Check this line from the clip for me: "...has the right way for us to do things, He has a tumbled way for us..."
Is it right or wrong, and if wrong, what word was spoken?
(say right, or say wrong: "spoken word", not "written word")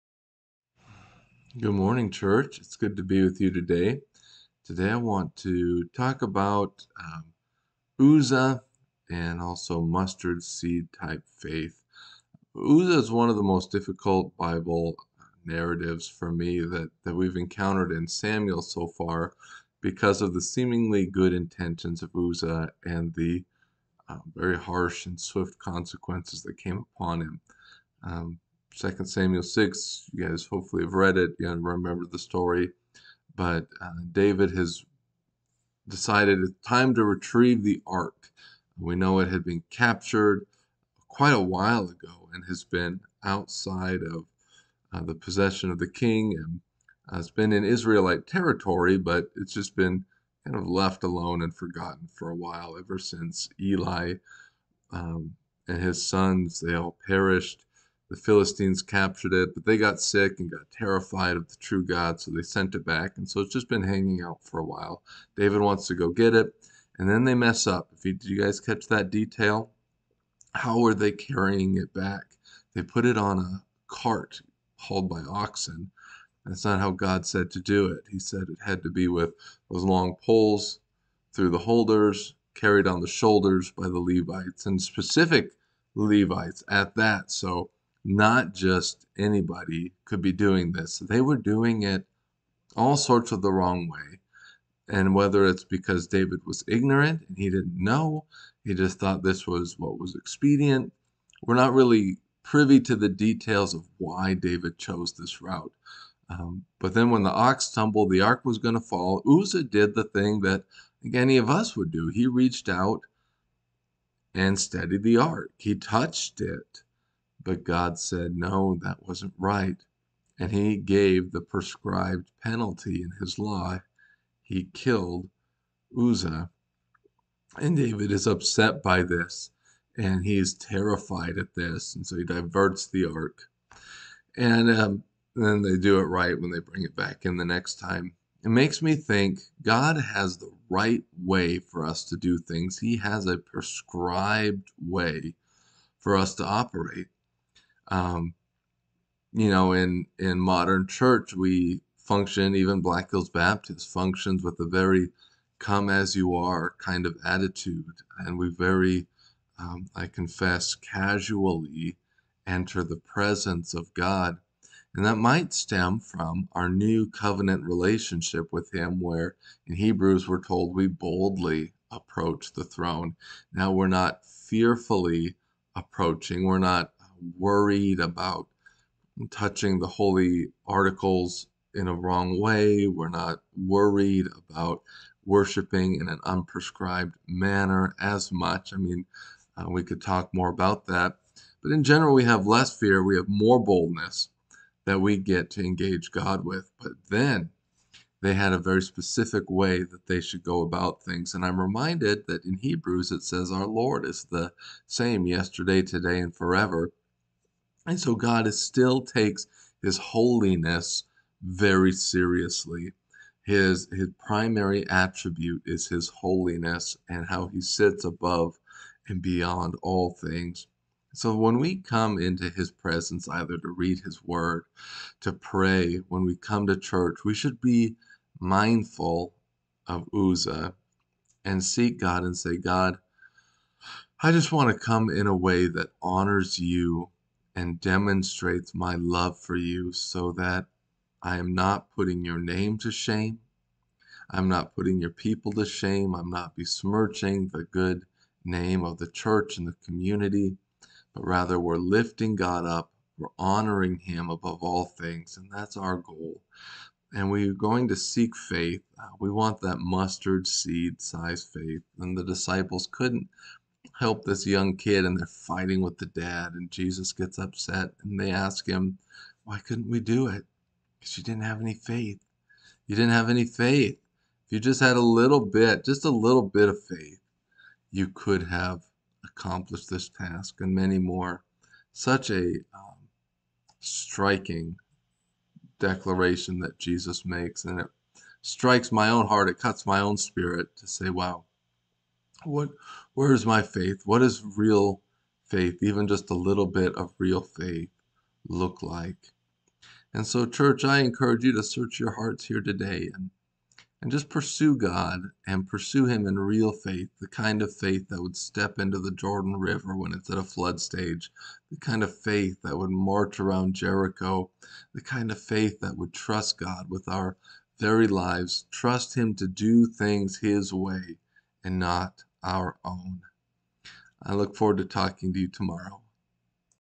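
wrong: "prescribed", not "tumbled".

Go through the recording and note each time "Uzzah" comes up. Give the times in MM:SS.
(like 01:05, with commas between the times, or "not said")
00:07, 00:12, 00:22, 01:49, 02:05, 03:50.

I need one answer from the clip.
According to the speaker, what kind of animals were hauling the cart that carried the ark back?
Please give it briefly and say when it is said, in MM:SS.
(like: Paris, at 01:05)
Oxen, at 01:15.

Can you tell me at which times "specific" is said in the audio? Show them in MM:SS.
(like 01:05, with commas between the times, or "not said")
01:24, 03:18.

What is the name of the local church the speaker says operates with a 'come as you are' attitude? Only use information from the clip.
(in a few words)
Black Hills Baptist.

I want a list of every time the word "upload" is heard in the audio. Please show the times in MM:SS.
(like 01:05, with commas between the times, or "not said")
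not said.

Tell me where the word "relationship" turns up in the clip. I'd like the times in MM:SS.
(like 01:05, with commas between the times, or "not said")
02:47.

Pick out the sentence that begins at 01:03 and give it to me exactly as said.
And so it's just been hanging out for a while.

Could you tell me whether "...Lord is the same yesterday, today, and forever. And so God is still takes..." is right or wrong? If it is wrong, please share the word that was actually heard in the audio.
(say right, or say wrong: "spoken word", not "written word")
right.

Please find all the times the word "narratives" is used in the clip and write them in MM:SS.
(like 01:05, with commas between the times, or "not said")
00:15.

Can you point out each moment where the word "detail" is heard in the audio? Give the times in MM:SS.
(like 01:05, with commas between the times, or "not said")
01:09, 01:43.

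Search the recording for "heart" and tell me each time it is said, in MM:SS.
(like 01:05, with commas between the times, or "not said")
04:49, 05:02.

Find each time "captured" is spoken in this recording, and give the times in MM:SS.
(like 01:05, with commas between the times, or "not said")
00:39, 00:58.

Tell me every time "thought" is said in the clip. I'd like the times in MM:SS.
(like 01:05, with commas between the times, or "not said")
01:38.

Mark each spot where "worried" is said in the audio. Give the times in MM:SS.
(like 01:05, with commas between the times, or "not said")
02:57, 03:03.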